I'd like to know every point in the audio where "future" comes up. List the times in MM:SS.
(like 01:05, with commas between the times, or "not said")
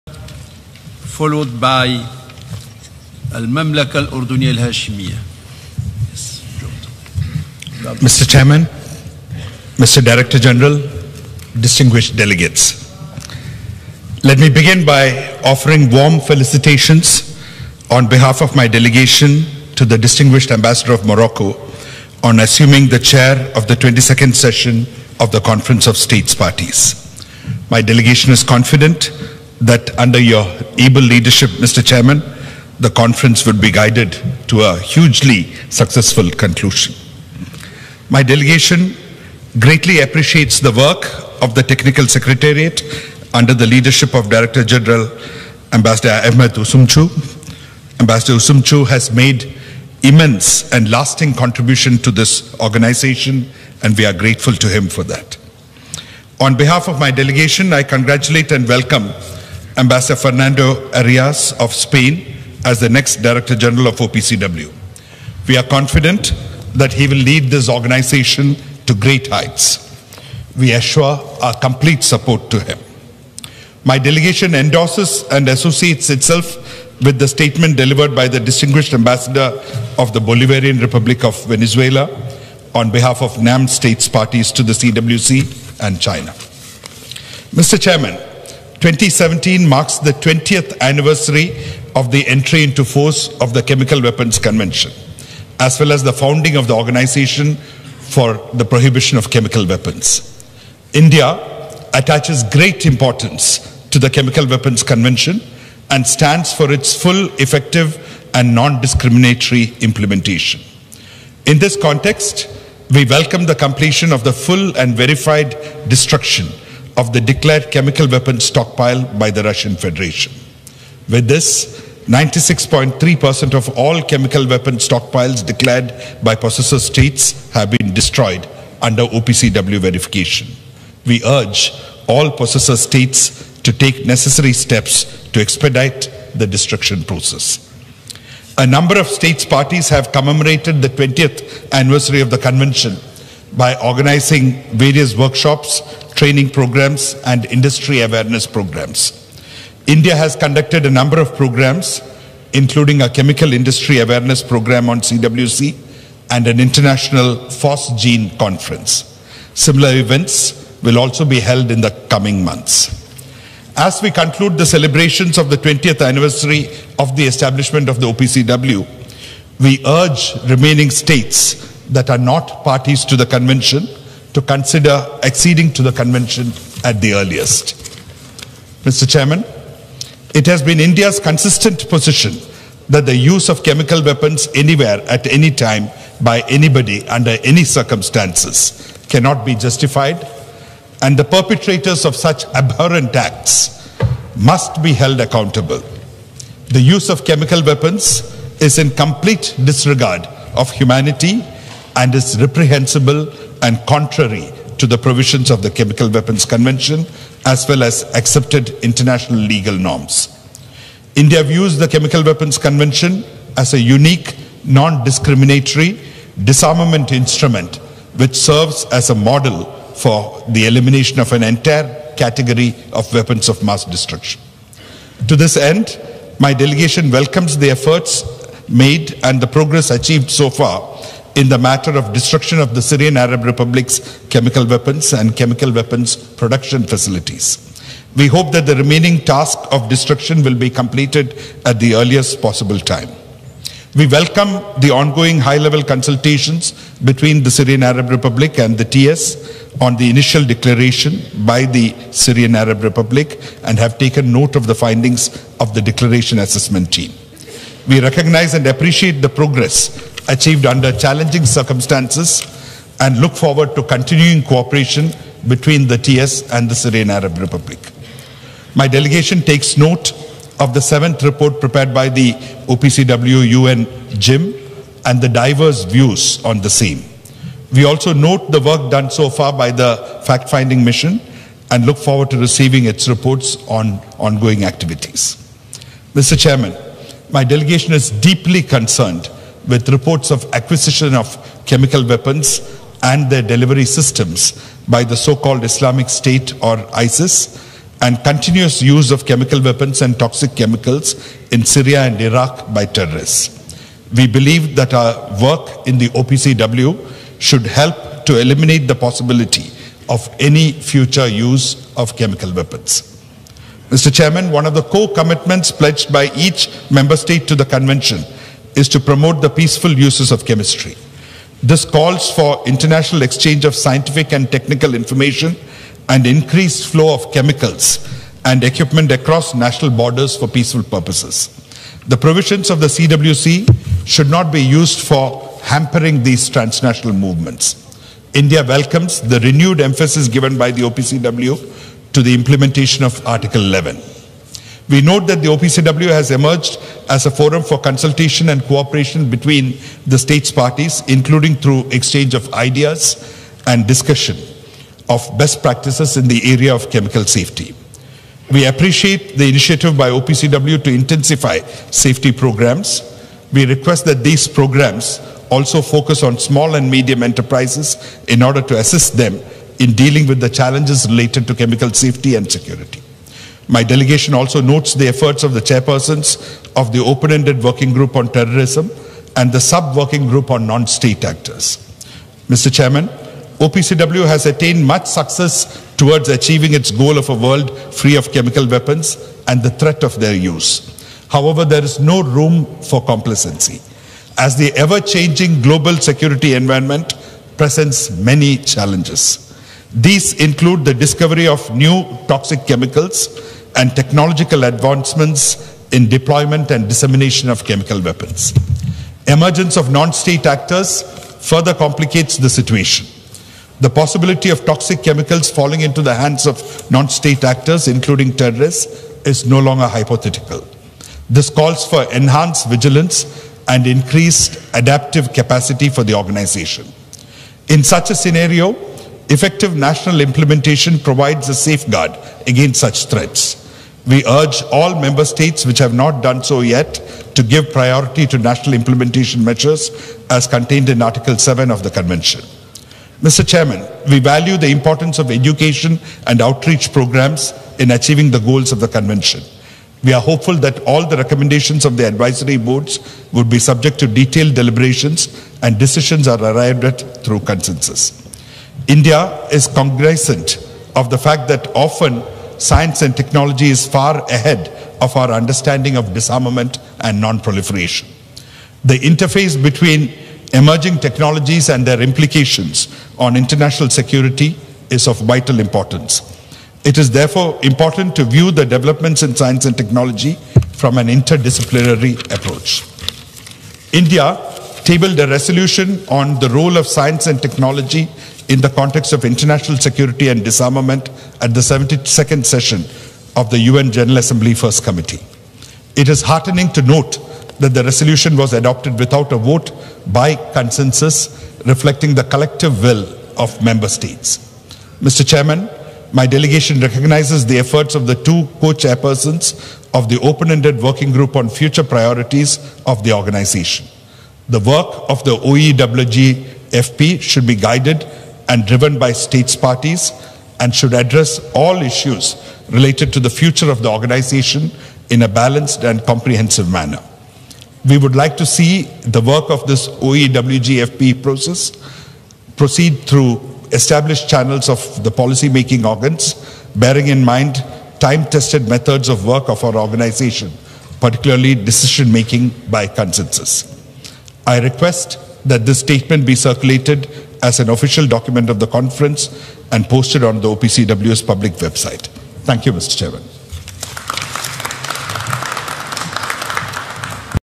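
05:10, 08:31, 08:43.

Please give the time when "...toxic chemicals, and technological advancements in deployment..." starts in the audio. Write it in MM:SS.
06:42.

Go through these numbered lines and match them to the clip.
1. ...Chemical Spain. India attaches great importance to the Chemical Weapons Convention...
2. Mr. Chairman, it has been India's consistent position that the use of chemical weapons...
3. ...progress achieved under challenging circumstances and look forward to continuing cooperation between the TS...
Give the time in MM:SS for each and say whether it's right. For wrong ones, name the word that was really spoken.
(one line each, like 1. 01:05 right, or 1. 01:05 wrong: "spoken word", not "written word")
1. 01:39 wrong: "Weapons", not "Spain"
2. 02:58 right
3. 04:19 right.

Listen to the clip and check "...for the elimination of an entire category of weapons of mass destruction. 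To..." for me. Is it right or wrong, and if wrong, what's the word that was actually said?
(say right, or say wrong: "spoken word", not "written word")
right.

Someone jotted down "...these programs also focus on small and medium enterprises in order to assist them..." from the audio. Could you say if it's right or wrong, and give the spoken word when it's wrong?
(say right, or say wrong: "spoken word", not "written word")
right.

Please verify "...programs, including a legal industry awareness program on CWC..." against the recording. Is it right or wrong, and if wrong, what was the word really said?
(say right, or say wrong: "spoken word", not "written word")
wrong: "chemical", not "legal".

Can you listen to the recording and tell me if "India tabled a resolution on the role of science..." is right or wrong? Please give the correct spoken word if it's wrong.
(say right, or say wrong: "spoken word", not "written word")
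right.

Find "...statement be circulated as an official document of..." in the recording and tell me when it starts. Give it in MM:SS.
09:05.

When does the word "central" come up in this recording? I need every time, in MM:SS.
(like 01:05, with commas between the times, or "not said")
not said.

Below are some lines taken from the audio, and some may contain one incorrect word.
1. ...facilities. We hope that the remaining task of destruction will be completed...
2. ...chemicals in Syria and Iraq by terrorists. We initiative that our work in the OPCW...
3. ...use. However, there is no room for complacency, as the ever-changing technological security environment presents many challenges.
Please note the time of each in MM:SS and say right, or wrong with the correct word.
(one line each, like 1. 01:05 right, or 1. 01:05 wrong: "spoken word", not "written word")
1. 03:56 right
2. 05:00 wrong: "believe", not "initiative"
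3. 06:30 wrong: "global", not "technological".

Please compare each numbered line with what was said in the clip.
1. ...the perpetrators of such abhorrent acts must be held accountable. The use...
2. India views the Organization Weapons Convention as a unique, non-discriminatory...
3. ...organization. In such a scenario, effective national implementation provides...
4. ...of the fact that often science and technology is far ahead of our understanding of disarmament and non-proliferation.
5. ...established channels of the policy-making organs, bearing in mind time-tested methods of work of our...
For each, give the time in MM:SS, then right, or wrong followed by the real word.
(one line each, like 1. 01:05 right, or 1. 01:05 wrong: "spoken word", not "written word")
1. 03:11 right
2. 03:31 wrong: "Chemical", not "Organization"
3. 07:06 right
4. 07:40 right
5. 08:53 right.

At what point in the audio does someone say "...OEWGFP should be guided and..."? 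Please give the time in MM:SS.
08:35.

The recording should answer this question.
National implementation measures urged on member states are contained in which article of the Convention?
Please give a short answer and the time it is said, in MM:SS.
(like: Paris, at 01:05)
Article 7, at 07:21.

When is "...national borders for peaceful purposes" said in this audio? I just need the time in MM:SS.
05:29.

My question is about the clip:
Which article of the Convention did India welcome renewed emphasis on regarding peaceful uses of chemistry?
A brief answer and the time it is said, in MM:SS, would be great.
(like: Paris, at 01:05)
Article 11, at 05:43.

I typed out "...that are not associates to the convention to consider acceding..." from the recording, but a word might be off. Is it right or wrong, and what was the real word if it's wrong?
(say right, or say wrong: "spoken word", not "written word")
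wrong: "parties", not "associates".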